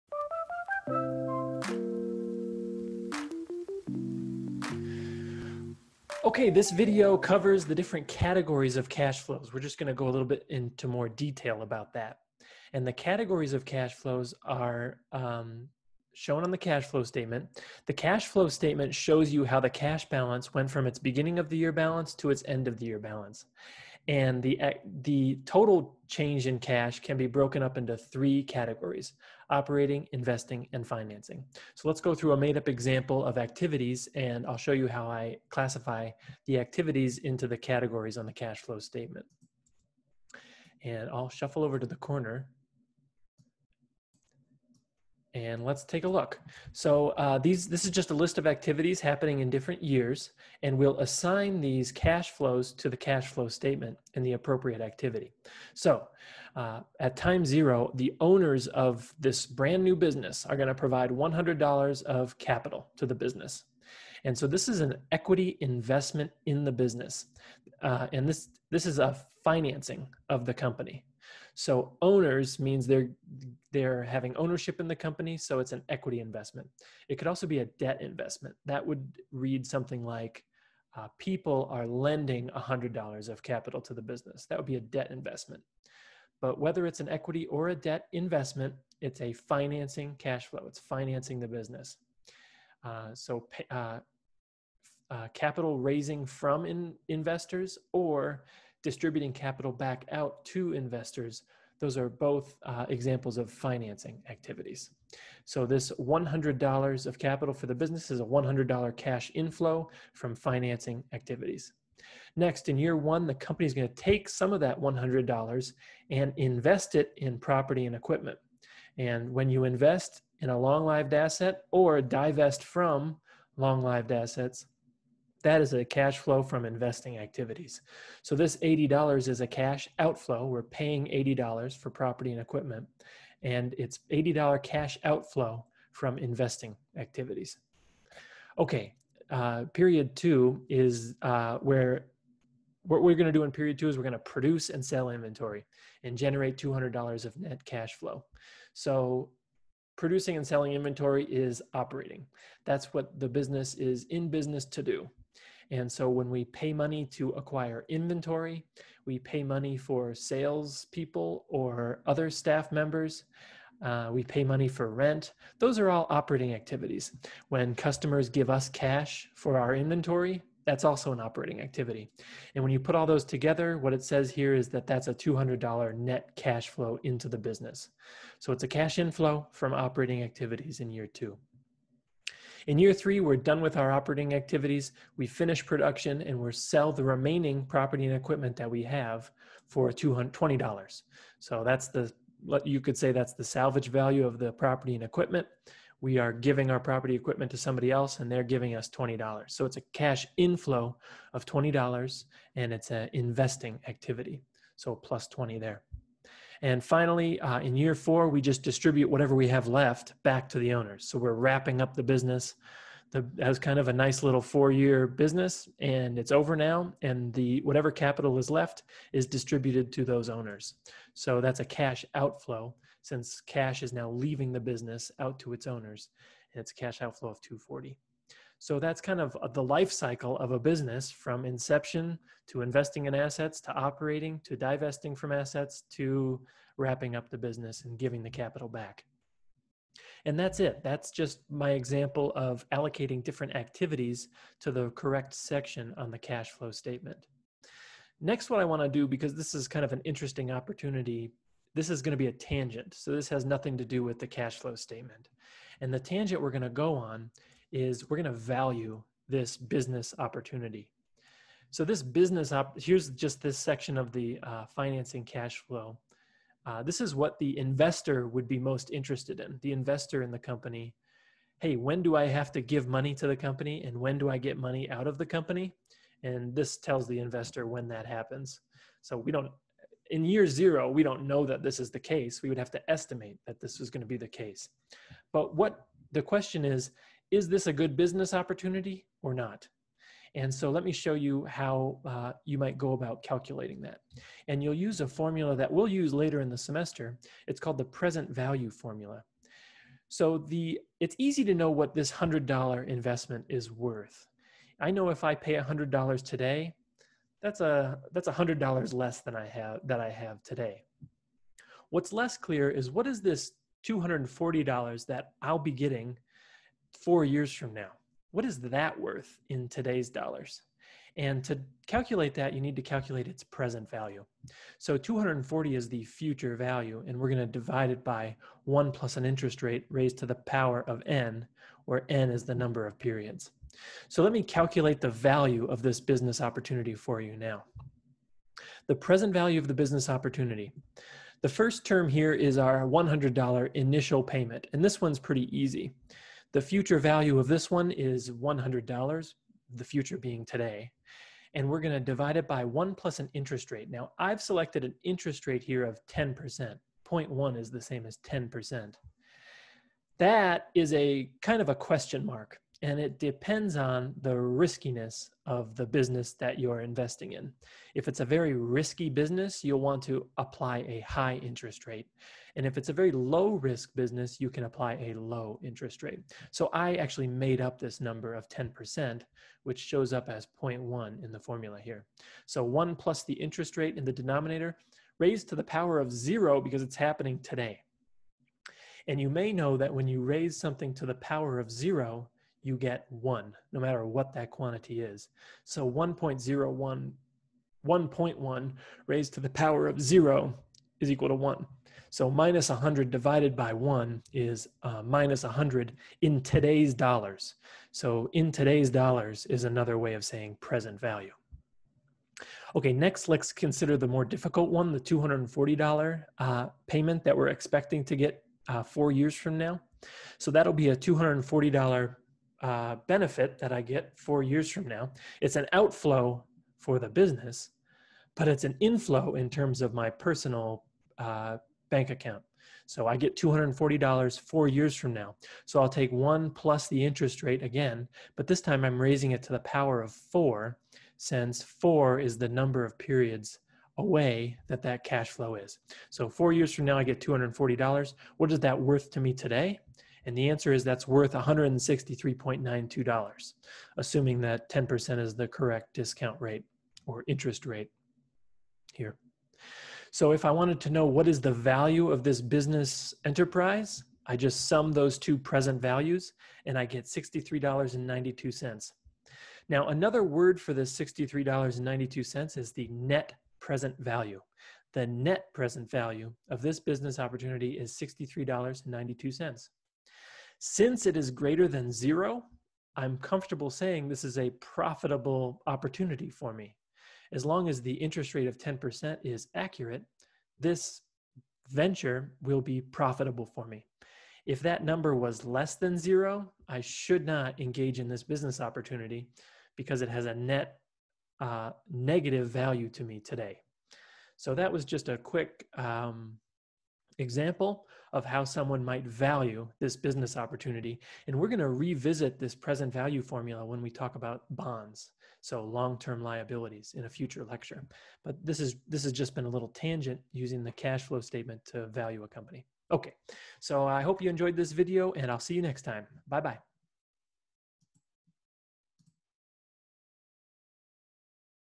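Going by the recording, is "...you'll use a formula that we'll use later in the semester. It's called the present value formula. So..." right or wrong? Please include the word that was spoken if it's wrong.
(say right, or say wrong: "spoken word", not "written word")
right.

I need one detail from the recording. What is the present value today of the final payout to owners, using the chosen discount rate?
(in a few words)
$163.92.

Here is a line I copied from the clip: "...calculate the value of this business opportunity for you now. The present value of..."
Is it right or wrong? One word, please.
right.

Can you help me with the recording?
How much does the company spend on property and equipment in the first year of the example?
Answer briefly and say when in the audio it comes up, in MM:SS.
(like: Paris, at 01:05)
$80, at 02:08.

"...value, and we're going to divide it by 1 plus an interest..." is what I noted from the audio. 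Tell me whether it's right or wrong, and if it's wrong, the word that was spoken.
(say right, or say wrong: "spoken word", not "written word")
right.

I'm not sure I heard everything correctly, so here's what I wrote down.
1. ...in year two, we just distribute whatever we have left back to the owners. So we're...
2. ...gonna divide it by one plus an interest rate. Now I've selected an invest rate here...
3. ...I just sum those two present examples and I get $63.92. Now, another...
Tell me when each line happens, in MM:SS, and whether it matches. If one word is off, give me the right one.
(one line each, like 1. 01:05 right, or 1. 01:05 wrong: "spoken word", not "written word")
1. 03:27 wrong: "four", not "two"
2. 05:51 wrong: "interest", not "invest"
3. 07:44 wrong: "values", not "examples".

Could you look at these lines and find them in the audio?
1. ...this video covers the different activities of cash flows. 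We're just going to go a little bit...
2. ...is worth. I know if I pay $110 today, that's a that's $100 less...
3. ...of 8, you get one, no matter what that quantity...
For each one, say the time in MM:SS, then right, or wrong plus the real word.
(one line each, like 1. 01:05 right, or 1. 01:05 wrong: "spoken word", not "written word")
1. 00:06 wrong: "categories", not "activities"
2. 05:03 wrong: "100", not "110"
3. 06:31 wrong: "0", not "8".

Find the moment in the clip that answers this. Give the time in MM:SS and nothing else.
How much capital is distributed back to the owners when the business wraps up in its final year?
03:46.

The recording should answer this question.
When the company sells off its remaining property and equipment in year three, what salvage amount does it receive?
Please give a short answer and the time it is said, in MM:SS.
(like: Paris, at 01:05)
$20, at 03:18.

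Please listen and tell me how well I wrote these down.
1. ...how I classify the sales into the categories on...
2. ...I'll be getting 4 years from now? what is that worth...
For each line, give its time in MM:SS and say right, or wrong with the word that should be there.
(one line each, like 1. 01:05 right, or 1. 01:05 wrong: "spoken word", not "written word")
1. 00:34 wrong: "activities", not "sales"
2. 05:15 right.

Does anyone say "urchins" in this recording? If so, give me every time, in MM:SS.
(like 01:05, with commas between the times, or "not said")
not said.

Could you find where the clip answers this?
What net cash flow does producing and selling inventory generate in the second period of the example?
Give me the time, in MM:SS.
02:26.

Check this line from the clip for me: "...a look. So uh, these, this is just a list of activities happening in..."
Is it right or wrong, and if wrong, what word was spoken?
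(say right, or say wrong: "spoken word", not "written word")
right.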